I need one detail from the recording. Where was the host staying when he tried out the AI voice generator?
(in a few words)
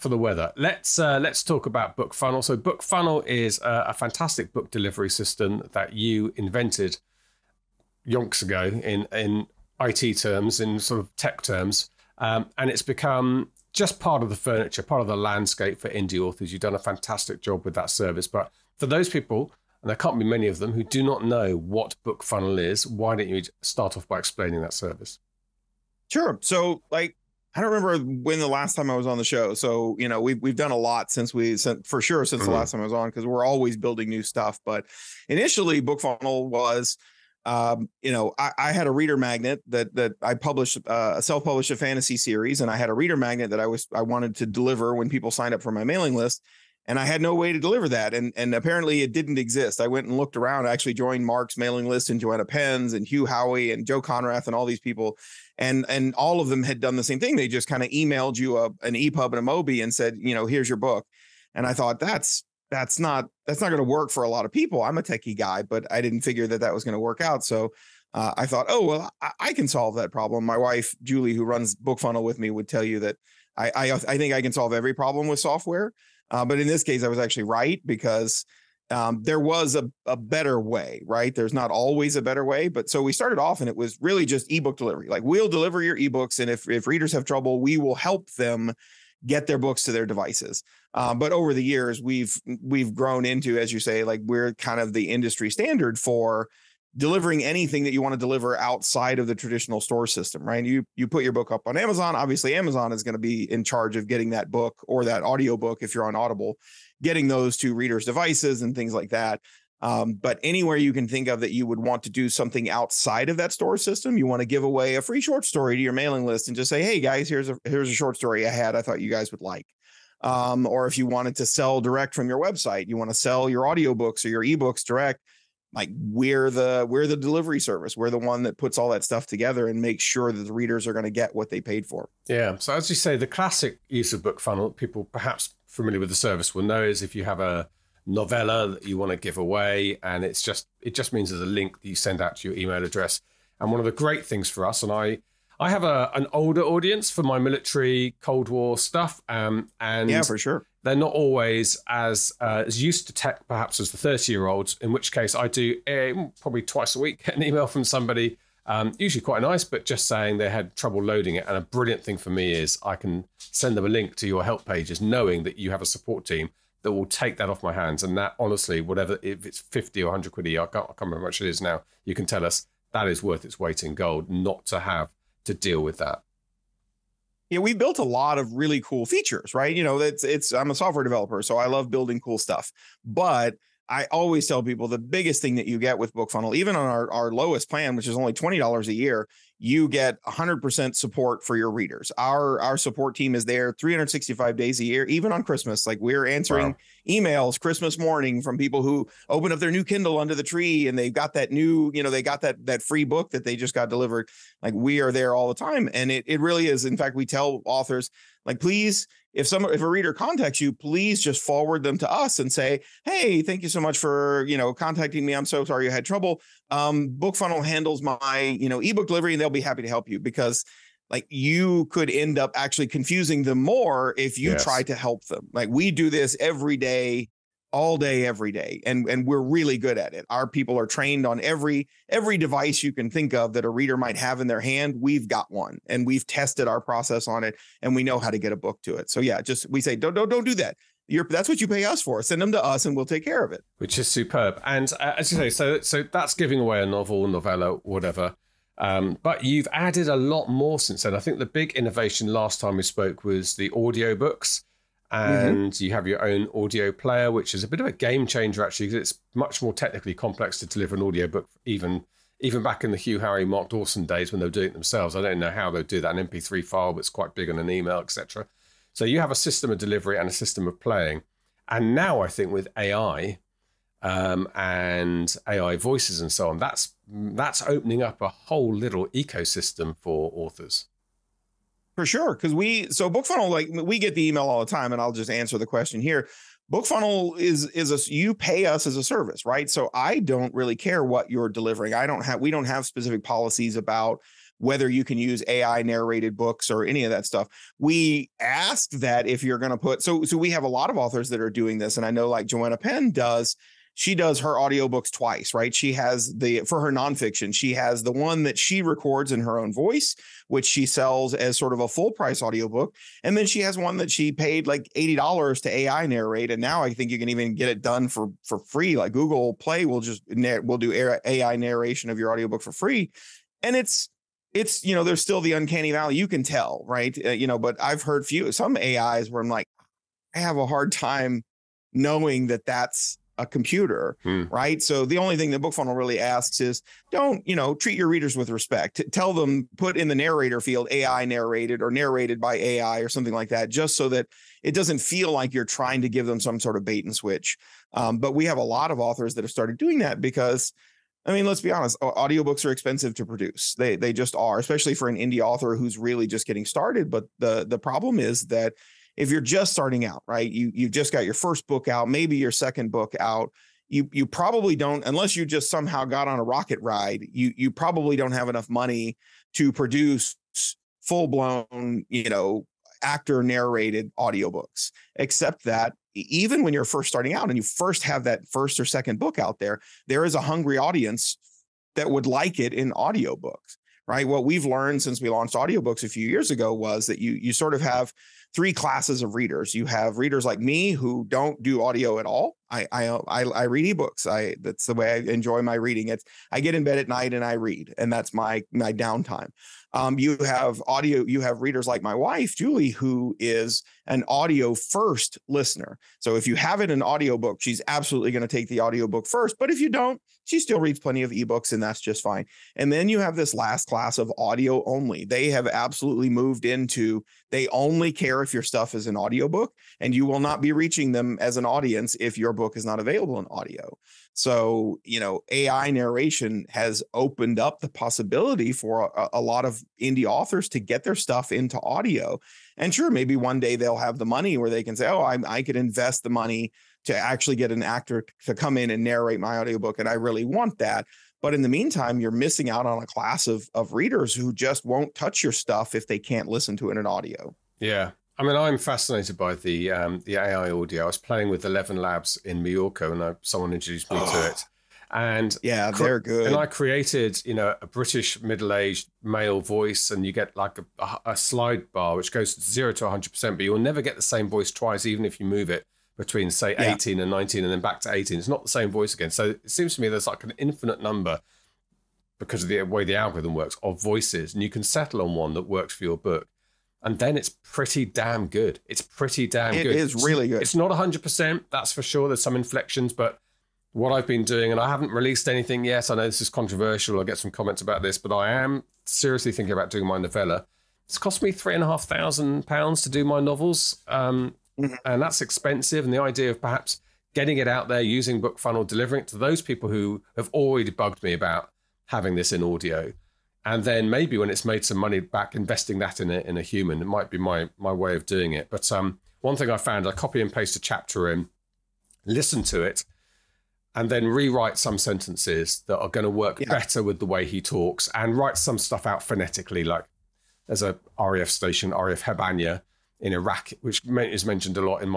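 Mallorca.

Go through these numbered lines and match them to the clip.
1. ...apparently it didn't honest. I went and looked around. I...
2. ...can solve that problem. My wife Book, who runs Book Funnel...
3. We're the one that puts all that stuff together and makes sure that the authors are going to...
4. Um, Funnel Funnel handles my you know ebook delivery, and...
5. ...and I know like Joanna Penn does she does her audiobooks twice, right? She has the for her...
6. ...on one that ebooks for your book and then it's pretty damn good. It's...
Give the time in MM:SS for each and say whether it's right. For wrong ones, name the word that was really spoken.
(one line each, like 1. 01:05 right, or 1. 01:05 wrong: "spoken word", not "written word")
1. 00:48 wrong: "exist", not "honest"
2. 01:09 wrong: "Julie", not "Book"
3. 02:07 wrong: "readers", not "authors"
4. 03:36 wrong: "Book", not "Funnel"
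5. 05:01 right
6. 07:55 wrong: "works", not "ebooks".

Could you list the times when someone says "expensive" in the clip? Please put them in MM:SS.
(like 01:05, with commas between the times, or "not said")
05:52, 08:15.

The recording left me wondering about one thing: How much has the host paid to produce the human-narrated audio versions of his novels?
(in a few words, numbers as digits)
3,500 pounds.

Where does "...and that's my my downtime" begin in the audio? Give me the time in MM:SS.
06:37.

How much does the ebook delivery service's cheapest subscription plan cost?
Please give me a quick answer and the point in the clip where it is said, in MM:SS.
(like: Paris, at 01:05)
$20 a year, at 03:08.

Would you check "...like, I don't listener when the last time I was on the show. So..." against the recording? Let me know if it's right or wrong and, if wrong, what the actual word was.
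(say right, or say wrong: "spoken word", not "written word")
wrong: "remember", not "listener".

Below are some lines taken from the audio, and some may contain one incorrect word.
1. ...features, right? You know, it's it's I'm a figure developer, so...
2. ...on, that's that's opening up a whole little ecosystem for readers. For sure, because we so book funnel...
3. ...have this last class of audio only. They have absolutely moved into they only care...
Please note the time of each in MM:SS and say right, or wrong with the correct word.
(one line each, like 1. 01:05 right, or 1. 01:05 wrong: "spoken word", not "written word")
1. 02:59 wrong: "software", not "figure"
2. 04:36 wrong: "authors", not "readers"
3. 06:53 right.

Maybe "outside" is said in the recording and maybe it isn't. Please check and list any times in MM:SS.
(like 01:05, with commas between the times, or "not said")
01:38, 01:52.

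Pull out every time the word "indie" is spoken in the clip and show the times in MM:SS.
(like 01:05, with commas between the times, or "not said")
00:15, 05:55, 07:10.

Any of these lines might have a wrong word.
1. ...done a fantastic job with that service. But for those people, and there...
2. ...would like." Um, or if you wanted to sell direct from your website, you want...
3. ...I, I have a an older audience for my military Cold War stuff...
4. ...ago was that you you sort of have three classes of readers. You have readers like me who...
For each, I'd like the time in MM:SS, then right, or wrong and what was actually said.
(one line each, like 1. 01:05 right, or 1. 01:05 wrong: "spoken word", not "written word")
1. 00:16 right
2. 01:59 right
3. 02:24 right
4. 06:26 right.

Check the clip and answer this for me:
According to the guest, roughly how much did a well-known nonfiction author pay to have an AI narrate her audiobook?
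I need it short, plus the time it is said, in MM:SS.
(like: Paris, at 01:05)
$80, at 05:14.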